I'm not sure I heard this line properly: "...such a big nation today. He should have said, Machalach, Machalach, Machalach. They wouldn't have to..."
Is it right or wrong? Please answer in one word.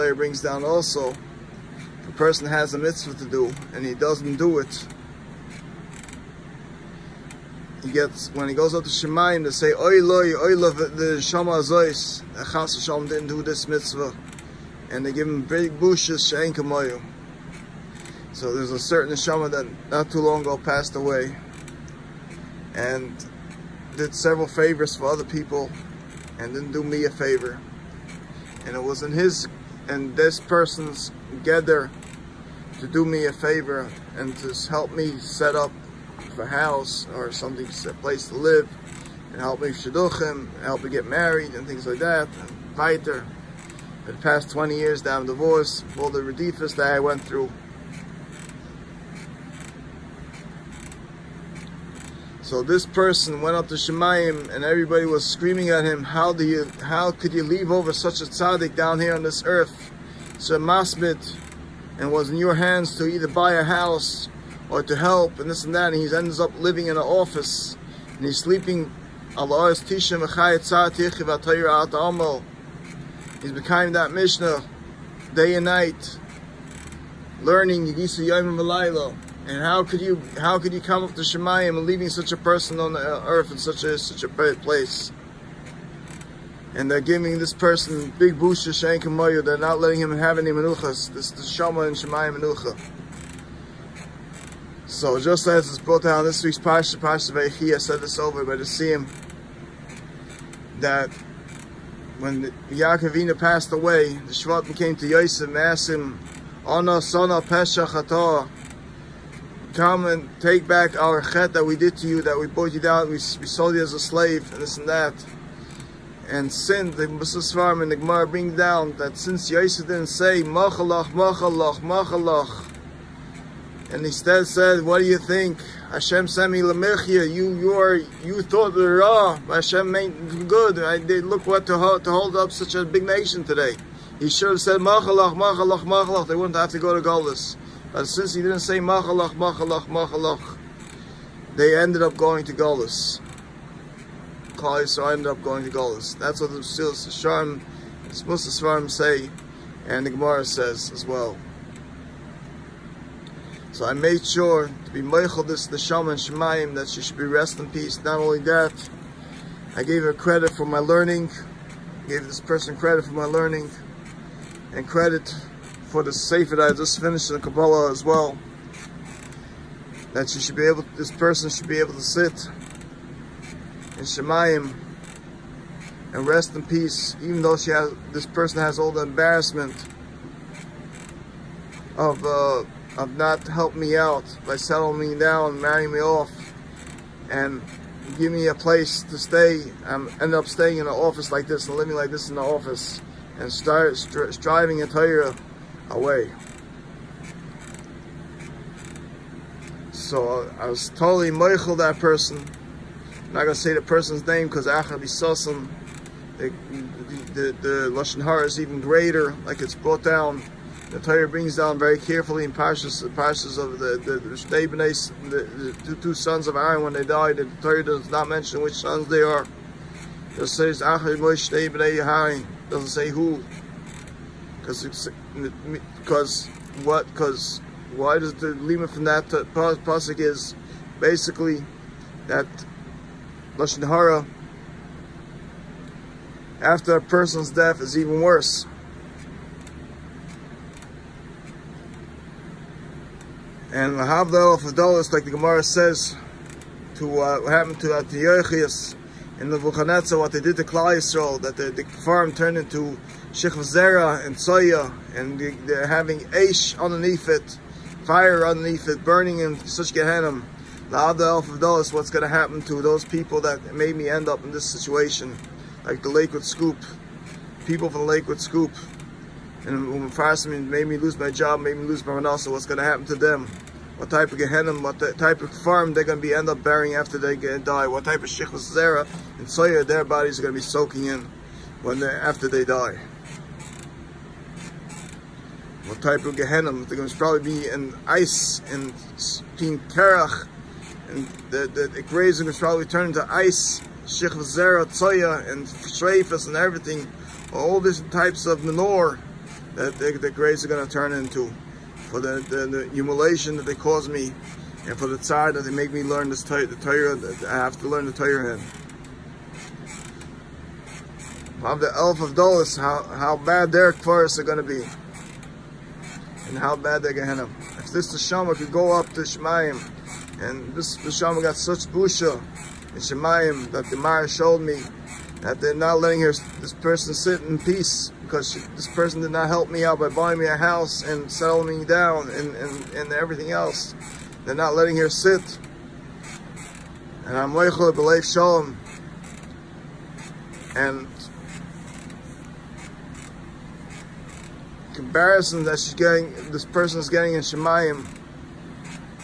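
right.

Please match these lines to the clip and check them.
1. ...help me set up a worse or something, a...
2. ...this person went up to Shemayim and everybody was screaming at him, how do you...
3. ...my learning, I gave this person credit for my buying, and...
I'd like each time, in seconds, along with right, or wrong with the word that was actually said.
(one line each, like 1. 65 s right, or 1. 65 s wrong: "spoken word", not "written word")
1. 34 s wrong: "house", not "worse"
2. 52 s right
3. 160 s wrong: "learning", not "buying".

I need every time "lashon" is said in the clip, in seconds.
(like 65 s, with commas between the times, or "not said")
207 s, 233 s.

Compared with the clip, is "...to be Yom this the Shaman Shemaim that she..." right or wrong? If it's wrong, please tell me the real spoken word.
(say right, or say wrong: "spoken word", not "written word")
wrong: "Meichel", not "Yom".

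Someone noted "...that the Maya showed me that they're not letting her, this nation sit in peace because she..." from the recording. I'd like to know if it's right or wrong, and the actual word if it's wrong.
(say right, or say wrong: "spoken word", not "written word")
wrong: "person", not "nation".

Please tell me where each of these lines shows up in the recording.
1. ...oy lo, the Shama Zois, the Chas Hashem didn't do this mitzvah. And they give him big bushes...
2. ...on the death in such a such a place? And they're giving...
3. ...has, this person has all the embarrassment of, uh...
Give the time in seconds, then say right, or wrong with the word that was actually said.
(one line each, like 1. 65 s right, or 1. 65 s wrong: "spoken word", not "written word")
1. 10 s right
2. 82 s wrong: "earth", not "death"
3. 177 s right.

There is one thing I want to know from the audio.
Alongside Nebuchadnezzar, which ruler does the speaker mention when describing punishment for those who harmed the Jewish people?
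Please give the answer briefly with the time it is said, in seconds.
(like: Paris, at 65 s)
Antiochus, at 247 s.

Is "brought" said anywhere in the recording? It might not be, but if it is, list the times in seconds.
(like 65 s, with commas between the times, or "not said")
95 s, 209 s.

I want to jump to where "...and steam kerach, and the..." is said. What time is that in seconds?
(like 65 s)
288 s.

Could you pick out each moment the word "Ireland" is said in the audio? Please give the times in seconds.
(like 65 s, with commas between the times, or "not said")
not said.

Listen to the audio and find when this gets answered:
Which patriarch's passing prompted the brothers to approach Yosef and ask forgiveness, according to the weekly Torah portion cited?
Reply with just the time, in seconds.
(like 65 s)
102 s.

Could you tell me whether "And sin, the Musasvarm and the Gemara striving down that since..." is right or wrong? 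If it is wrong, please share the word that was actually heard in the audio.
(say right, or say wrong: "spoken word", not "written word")
wrong: "bring", not "striving".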